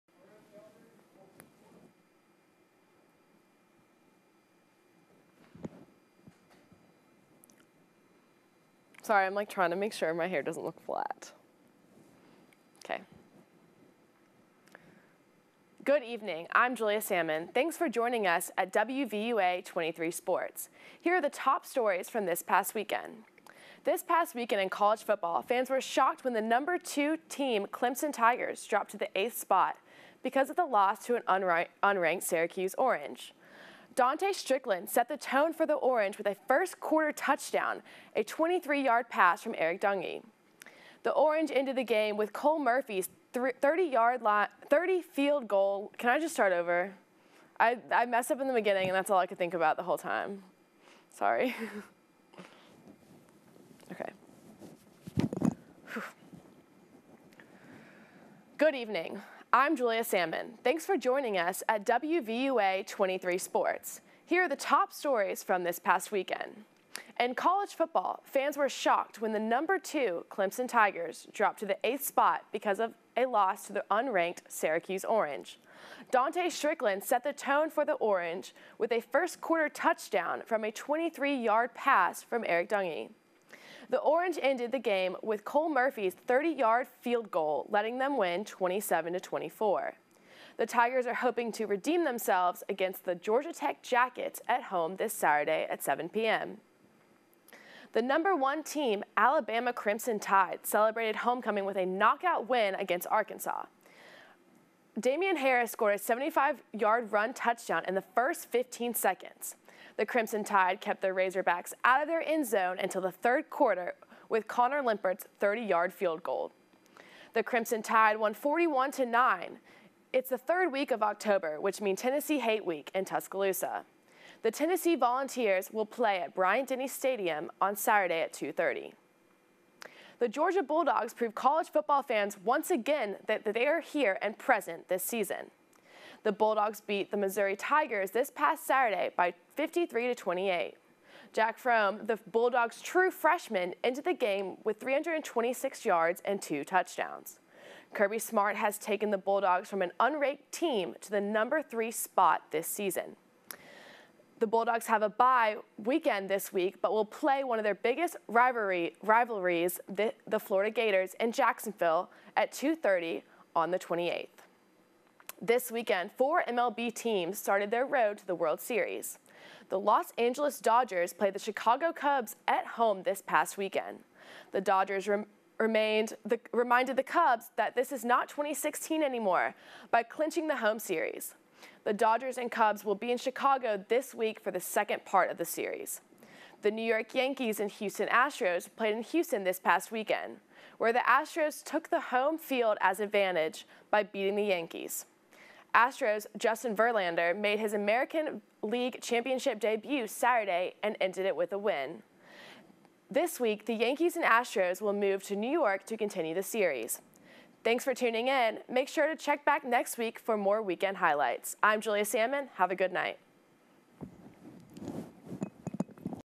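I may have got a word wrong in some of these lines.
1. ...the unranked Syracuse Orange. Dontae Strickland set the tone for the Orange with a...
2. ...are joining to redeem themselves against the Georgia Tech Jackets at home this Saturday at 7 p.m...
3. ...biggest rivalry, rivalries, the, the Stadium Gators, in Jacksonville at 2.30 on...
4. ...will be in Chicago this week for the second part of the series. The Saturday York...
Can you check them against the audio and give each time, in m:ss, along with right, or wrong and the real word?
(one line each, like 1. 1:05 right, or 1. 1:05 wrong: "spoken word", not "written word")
1. 1:13 right
2. 1:31 wrong: "hoping", not "joining"
3. 2:37 wrong: "Florida", not "Stadium"
4. 3:02 wrong: "New", not "Saturday".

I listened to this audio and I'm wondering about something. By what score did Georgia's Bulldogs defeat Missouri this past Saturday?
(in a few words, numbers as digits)
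53 to 28.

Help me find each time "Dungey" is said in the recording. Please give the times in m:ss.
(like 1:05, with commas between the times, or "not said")
0:39, 1:22.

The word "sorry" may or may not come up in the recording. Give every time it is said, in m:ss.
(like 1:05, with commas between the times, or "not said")
0:09, 0:51.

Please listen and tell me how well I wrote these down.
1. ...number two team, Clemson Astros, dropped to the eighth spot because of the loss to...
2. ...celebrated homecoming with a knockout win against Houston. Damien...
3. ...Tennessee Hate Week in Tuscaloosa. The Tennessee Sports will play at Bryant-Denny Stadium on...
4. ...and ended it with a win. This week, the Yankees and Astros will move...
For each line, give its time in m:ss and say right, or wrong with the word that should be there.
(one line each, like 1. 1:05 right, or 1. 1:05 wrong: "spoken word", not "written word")
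1. 0:26 wrong: "Tigers", not "Astros"
2. 1:40 wrong: "Arkansas", not "Houston"
3. 2:02 wrong: "Volunteers", not "Sports"
4. 3:20 right.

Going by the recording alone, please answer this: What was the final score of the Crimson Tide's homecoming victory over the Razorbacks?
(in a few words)
41 to 9.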